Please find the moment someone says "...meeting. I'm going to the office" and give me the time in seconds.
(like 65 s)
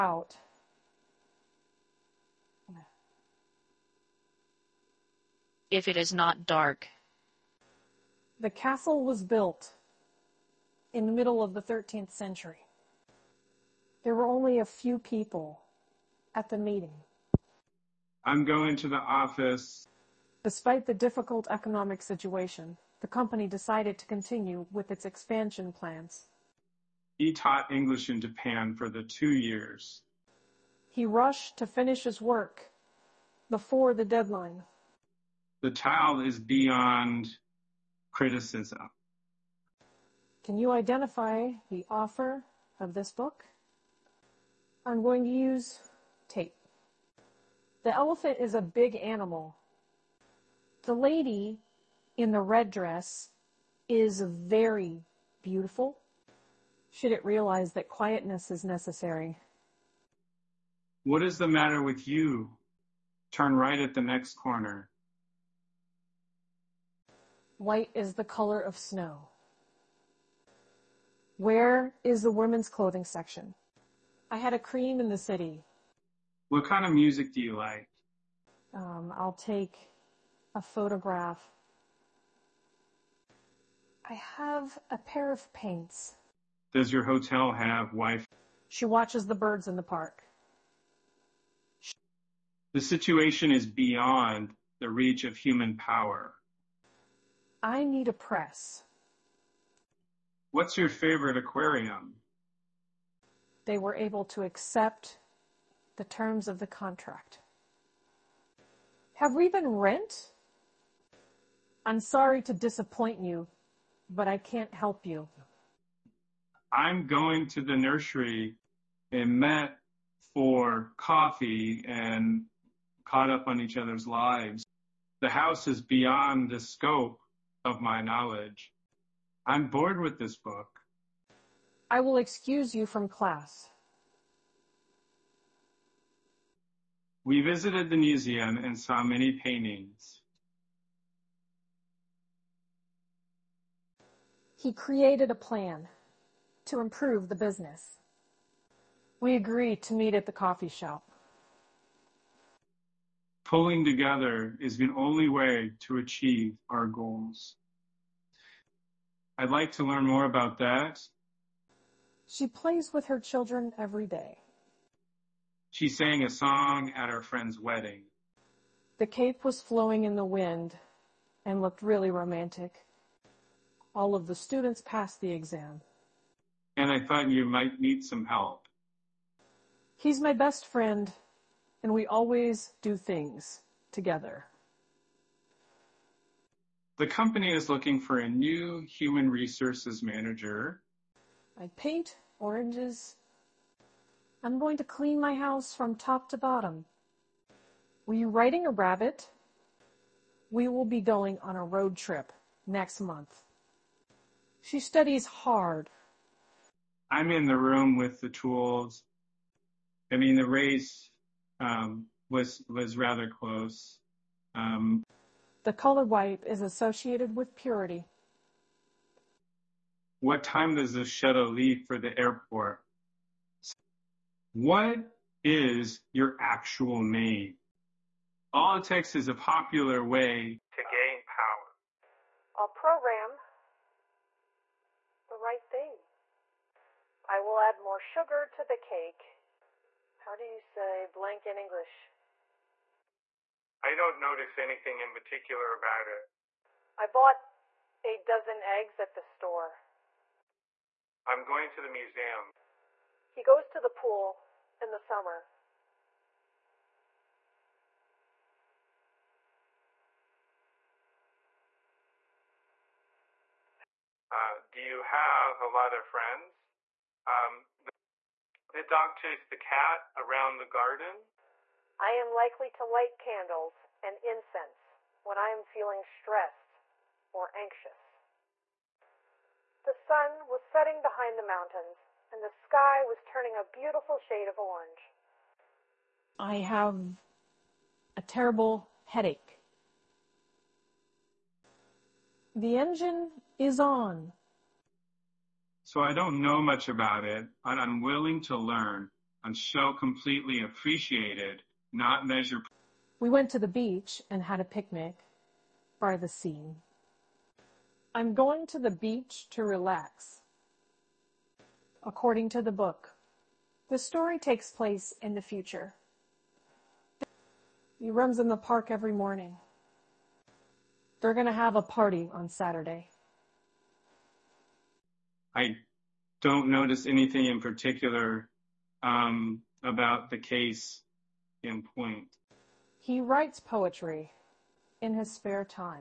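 16 s.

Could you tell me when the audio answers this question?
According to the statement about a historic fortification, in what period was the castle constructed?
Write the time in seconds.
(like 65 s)
11 s.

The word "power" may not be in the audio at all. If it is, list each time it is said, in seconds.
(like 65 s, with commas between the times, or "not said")
95 s, 231 s.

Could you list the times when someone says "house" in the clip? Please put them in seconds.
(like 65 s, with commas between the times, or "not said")
125 s, 195 s.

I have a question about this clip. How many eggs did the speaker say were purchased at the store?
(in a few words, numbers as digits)
a dozen.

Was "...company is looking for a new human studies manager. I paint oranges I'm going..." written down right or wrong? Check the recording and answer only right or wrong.
wrong.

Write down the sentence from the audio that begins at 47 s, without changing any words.
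The elephant is a big animal.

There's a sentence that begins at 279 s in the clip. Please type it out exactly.
The sun was setting behind the mountains and the sky was turning a beautiful shade of orange.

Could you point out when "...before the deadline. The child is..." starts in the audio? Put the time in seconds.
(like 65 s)
33 s.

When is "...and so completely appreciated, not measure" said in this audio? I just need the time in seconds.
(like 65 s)
299 s.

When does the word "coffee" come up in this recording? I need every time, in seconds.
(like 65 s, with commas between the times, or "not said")
120 s, 150 s.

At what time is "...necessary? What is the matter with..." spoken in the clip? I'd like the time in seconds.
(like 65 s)
58 s.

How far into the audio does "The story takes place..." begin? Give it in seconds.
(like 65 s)
313 s.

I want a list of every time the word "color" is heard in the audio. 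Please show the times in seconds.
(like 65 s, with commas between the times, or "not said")
68 s, 215 s.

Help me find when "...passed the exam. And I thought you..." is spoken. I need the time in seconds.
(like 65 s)
174 s.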